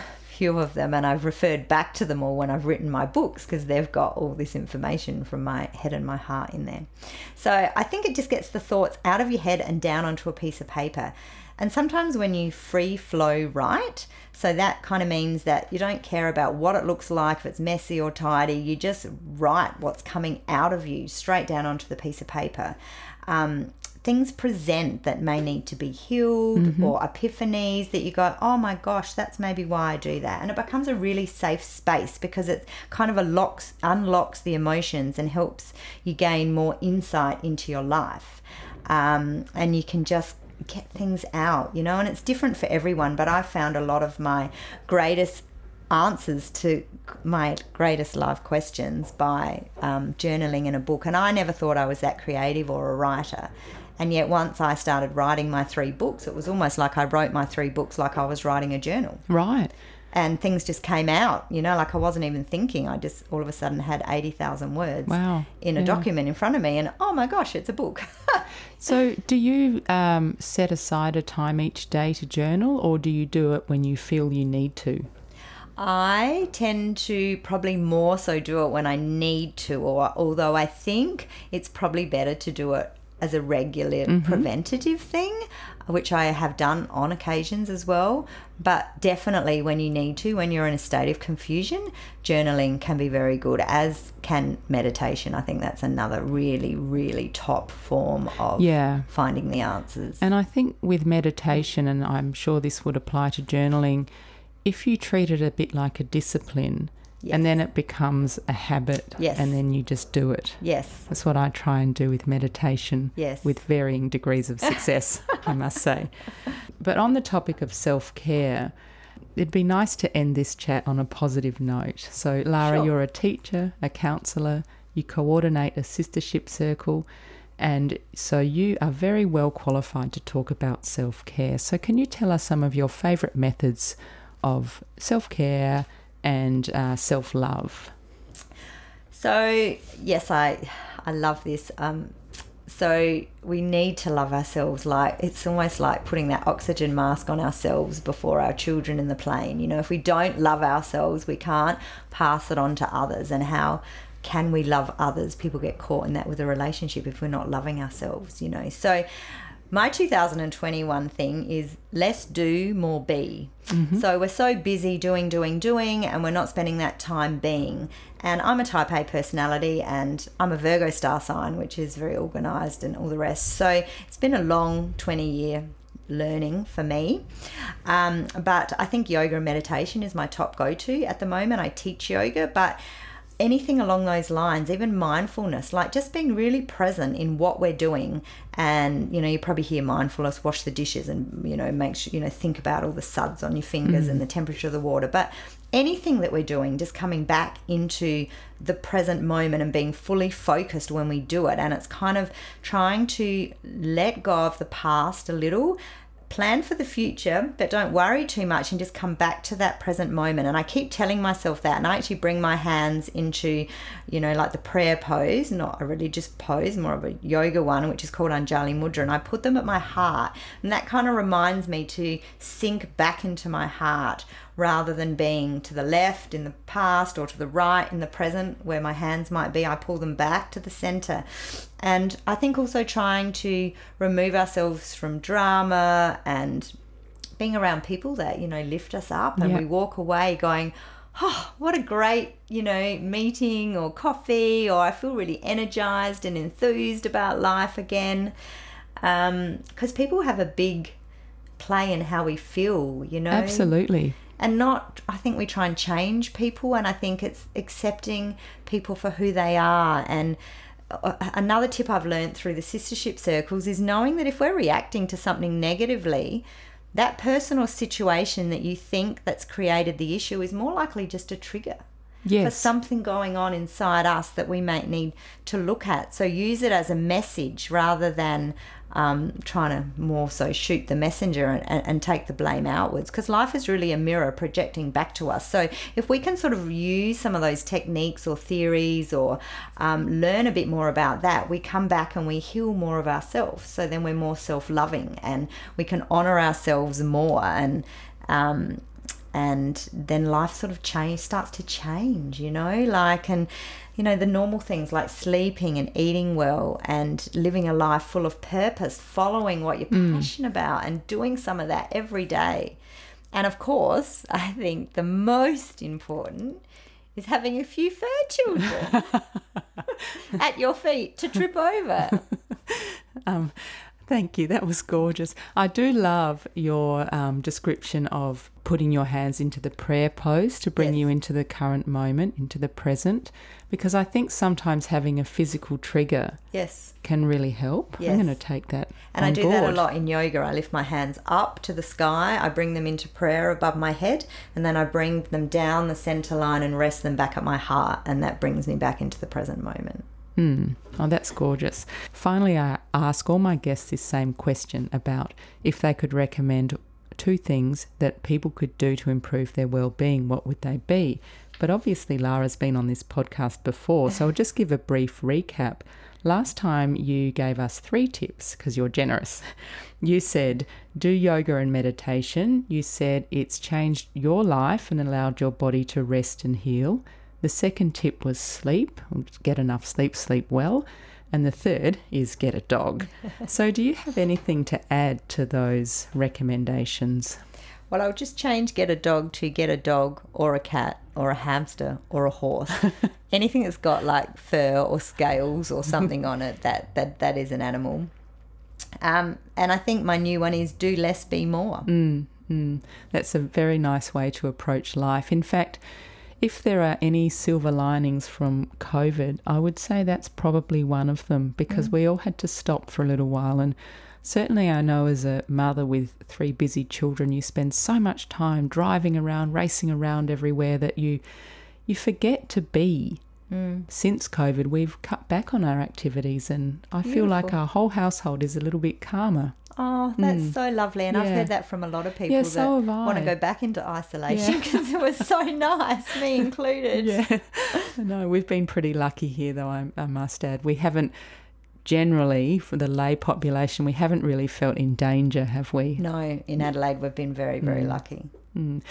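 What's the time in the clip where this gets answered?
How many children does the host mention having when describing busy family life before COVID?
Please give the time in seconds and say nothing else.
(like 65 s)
416 s.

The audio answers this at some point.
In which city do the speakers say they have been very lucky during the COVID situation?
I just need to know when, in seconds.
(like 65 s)
446 s.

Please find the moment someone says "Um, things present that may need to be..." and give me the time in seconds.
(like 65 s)
23 s.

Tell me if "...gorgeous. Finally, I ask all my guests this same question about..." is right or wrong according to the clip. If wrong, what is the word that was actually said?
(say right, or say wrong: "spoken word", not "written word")
right.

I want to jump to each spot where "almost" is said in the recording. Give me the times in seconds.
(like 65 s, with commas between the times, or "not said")
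56 s, 145 s.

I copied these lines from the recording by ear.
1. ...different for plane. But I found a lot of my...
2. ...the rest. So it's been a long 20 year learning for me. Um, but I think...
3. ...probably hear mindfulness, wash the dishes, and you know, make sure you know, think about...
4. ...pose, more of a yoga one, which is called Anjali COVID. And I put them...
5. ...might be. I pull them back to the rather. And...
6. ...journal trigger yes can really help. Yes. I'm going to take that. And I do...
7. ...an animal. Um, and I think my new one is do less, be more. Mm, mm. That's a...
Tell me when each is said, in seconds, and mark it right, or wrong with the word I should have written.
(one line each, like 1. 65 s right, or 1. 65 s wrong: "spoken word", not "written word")
1. 42 s wrong: "everyone", not "plane"
2. 173 s right
3. 189 s right
4. 216 s wrong: "Mudra", not "COVID"
5. 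229 s wrong: "center", not "rather"
6. 335 s wrong: "physical", not "journal"
7. 397 s right.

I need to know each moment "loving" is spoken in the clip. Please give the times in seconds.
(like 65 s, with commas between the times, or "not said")
157 s, 294 s.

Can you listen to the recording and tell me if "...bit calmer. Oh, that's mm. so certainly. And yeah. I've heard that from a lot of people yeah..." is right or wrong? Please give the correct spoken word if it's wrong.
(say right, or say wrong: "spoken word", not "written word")
wrong: "lovely", not "certainly".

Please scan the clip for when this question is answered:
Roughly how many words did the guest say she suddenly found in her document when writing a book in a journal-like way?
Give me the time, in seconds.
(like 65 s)
64 s.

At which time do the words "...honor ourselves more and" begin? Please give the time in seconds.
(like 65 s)
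296 s.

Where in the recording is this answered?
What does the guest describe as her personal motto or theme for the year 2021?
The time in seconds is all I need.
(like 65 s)
161 s.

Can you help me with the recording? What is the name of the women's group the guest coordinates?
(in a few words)
Sistership circle.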